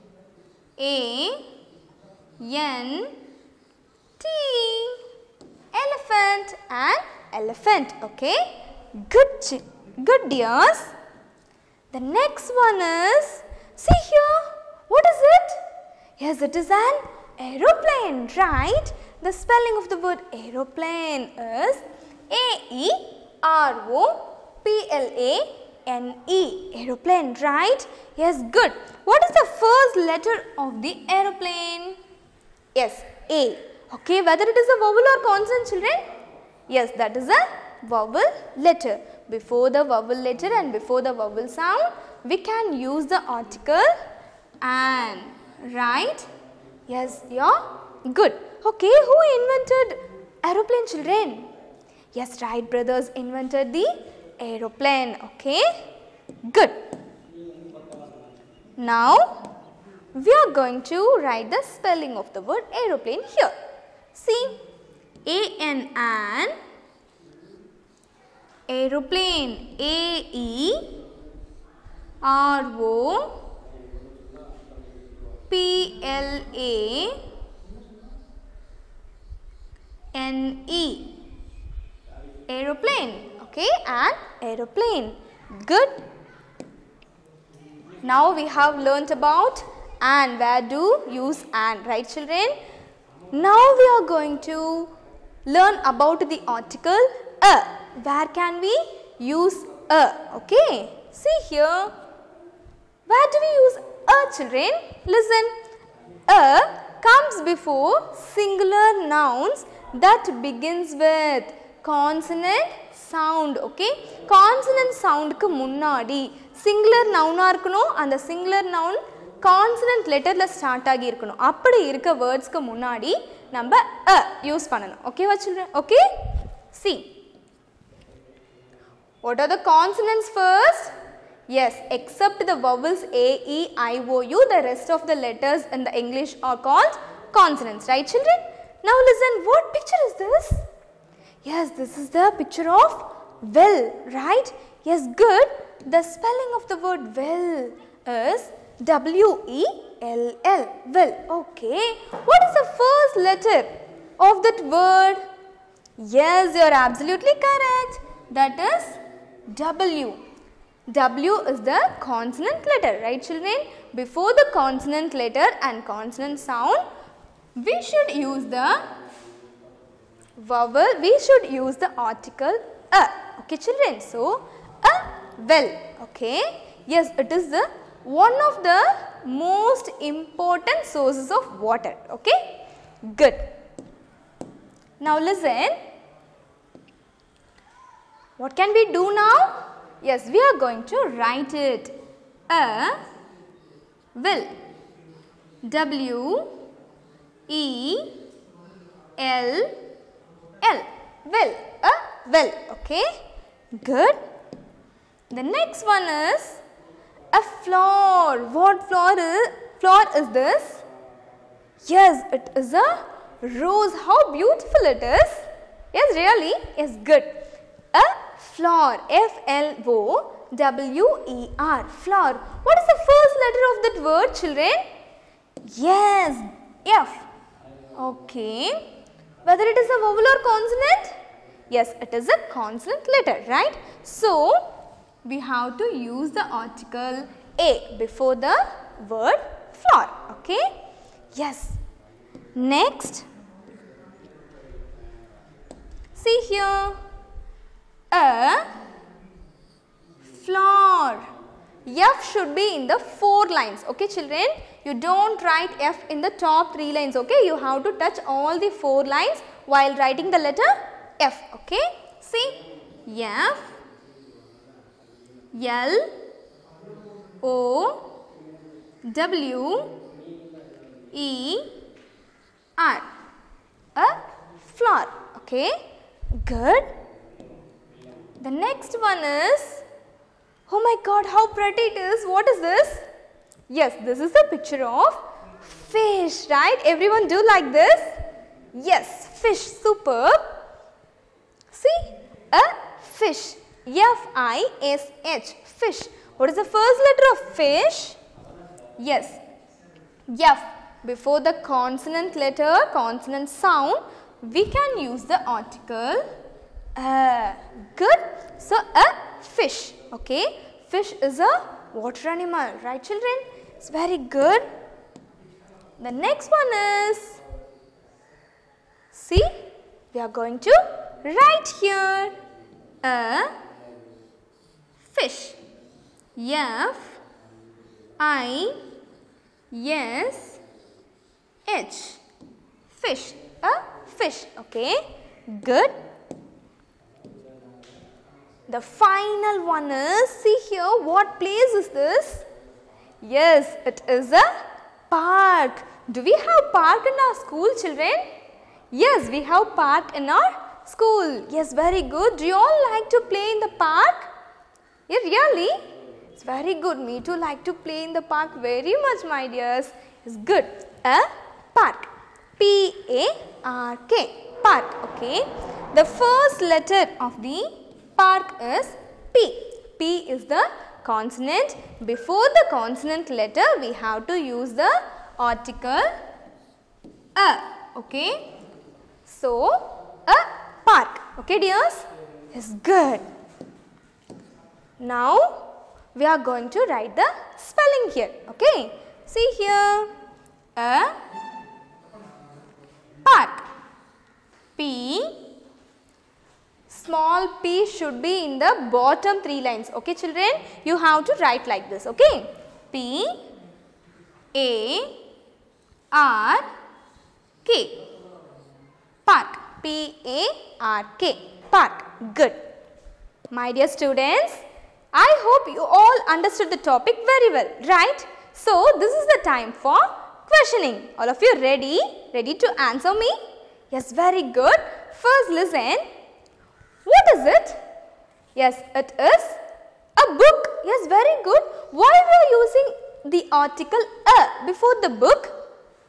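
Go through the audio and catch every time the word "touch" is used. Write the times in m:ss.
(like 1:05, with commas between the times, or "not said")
4:17.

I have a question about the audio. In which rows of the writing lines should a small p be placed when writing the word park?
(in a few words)
Bottom three lines.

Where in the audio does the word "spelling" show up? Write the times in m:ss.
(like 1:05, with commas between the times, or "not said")
0:19, 1:01, 2:26, 6:27.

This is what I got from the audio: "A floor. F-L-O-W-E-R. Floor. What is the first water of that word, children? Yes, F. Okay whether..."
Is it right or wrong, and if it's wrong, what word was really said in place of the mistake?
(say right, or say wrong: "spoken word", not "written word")
wrong: "letter", not "water".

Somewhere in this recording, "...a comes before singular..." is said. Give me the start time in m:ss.
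1:46.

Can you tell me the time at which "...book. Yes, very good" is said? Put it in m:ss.
7:10.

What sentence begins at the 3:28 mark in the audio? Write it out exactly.
What floor is, floor is this?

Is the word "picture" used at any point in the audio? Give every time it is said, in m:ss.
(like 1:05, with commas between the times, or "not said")
2:22, 4:44.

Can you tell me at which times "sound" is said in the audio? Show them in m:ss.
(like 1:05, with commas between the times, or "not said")
0:41, 2:46, 5:03.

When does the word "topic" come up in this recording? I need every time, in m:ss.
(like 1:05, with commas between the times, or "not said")
6:56.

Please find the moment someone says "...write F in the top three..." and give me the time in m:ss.
4:15.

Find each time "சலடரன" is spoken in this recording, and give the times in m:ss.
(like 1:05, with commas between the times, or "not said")
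2:05, 2:18.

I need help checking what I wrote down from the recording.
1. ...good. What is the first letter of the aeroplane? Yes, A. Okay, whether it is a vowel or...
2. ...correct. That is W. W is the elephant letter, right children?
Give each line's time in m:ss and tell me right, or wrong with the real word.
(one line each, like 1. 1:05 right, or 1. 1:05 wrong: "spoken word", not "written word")
1. 0:28 right
2. 2:37 wrong: "consonant", not "elephant".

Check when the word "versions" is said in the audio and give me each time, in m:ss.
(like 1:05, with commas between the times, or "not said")
not said.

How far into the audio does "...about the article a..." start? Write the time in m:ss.
1:35.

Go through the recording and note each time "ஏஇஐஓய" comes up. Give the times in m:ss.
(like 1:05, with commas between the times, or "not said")
2:13.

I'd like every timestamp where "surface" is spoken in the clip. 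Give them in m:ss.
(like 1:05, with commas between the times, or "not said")
not said.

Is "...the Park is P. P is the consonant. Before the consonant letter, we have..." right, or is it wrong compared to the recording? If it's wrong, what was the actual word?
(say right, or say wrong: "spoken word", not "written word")
right.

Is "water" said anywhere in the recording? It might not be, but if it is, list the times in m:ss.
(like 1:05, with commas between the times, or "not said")
3:01, 5:11.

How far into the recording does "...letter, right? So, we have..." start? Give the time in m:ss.
3:53.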